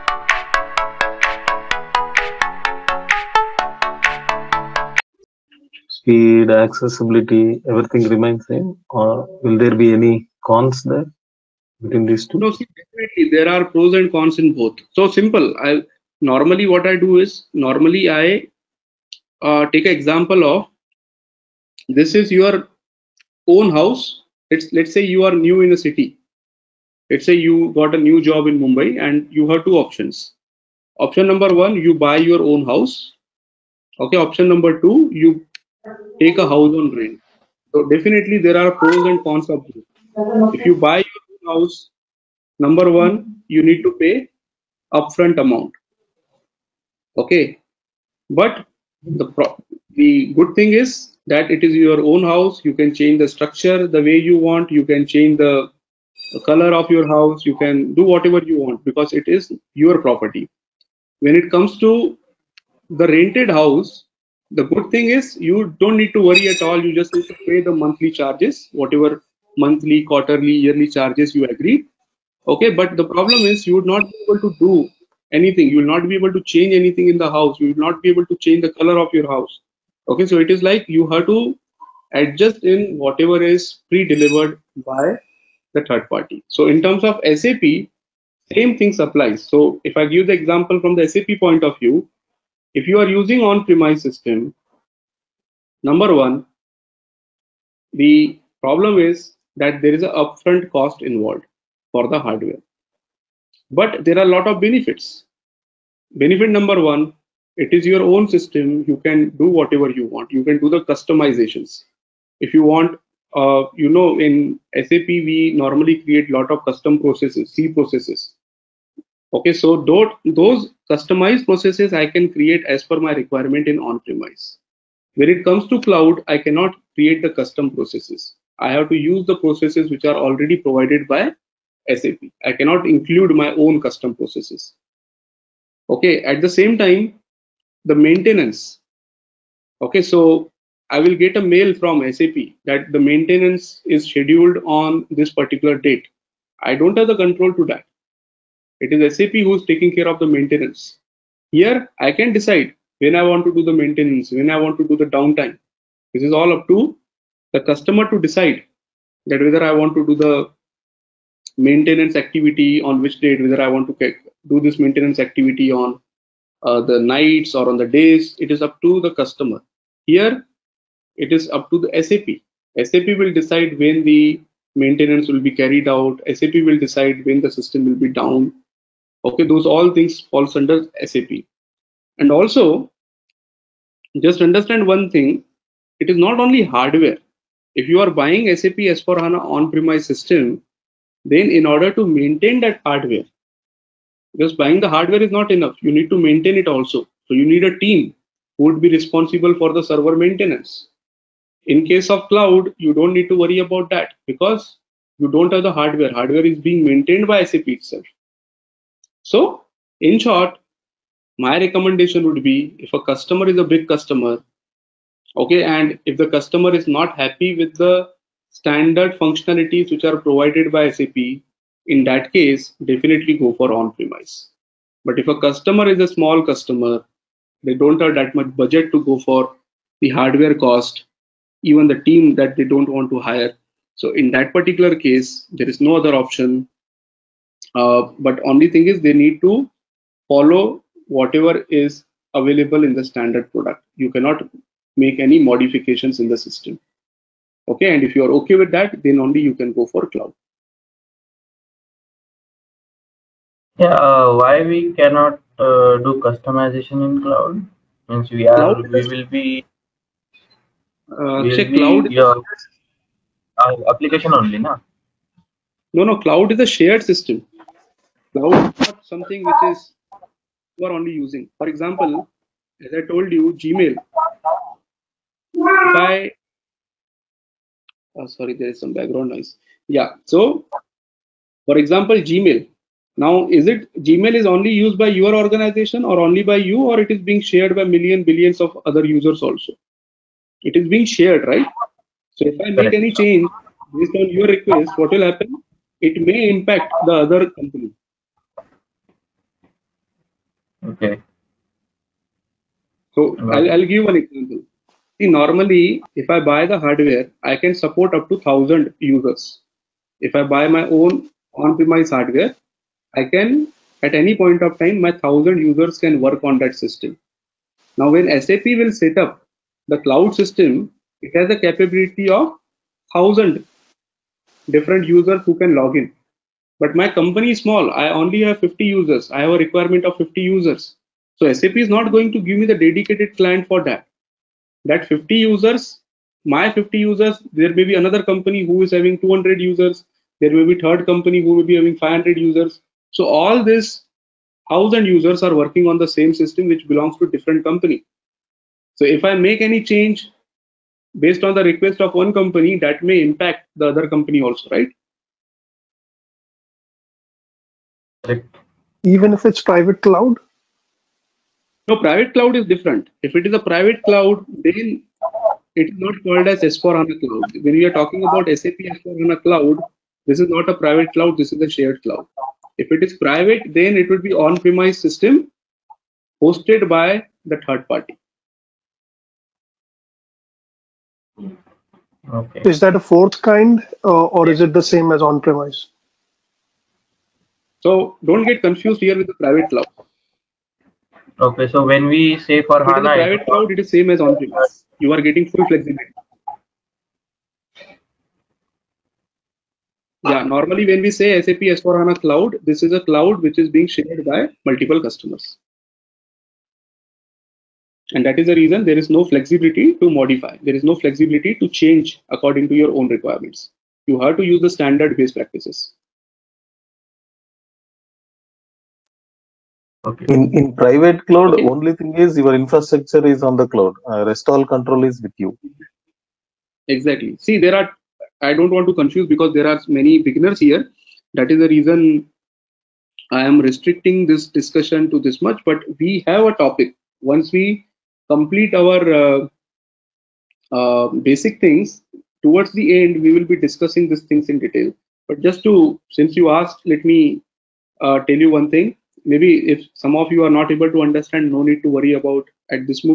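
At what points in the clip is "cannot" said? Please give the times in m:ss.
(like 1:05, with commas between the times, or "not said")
2:06, 2:12, 4:04, 4:14.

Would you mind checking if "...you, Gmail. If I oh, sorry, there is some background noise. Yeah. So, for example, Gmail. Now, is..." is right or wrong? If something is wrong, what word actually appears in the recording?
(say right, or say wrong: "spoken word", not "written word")
right.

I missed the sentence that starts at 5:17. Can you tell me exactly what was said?
Now, when SAP will set up the cloud system, it has the capability of 1000 different users who can log in.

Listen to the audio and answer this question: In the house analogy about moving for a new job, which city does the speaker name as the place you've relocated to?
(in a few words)
Mumbai.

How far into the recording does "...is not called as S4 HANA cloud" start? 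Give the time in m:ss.
6:05.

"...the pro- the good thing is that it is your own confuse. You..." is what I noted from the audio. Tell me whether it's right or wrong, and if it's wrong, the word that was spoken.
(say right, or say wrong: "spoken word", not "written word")
wrong: "house", not "confuse".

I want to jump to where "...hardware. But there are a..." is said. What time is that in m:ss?
1:42.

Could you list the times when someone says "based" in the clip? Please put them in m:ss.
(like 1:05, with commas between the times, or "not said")
4:53, 5:51, 6:55.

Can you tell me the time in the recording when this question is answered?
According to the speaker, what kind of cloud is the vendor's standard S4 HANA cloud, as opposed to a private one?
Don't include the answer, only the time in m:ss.
6:11.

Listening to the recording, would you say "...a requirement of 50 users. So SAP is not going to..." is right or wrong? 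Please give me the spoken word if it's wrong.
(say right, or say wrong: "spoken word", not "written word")
right.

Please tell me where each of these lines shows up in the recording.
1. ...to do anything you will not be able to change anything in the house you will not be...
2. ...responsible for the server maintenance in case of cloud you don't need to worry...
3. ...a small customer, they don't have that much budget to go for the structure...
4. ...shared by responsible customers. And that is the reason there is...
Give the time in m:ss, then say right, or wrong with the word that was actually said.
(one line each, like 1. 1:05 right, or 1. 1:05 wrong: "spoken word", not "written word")
1. 1:14 right
2. 3:18 right
3. 3:45 wrong: "hardware", not "structure"
4. 6:43 wrong: "multiple", not "responsible".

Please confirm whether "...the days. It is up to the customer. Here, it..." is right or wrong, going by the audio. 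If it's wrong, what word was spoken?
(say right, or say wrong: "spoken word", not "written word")
right.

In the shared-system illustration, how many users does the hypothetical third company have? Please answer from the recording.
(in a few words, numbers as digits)
500.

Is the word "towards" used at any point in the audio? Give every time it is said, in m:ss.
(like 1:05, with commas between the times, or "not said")
7:22.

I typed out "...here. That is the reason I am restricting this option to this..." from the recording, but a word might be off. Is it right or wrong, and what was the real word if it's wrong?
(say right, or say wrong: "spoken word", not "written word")
wrong: "discussion", not "option".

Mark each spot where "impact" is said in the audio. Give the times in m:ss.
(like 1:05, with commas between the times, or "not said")
4:56, 5:53.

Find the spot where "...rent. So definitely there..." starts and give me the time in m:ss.
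0:36.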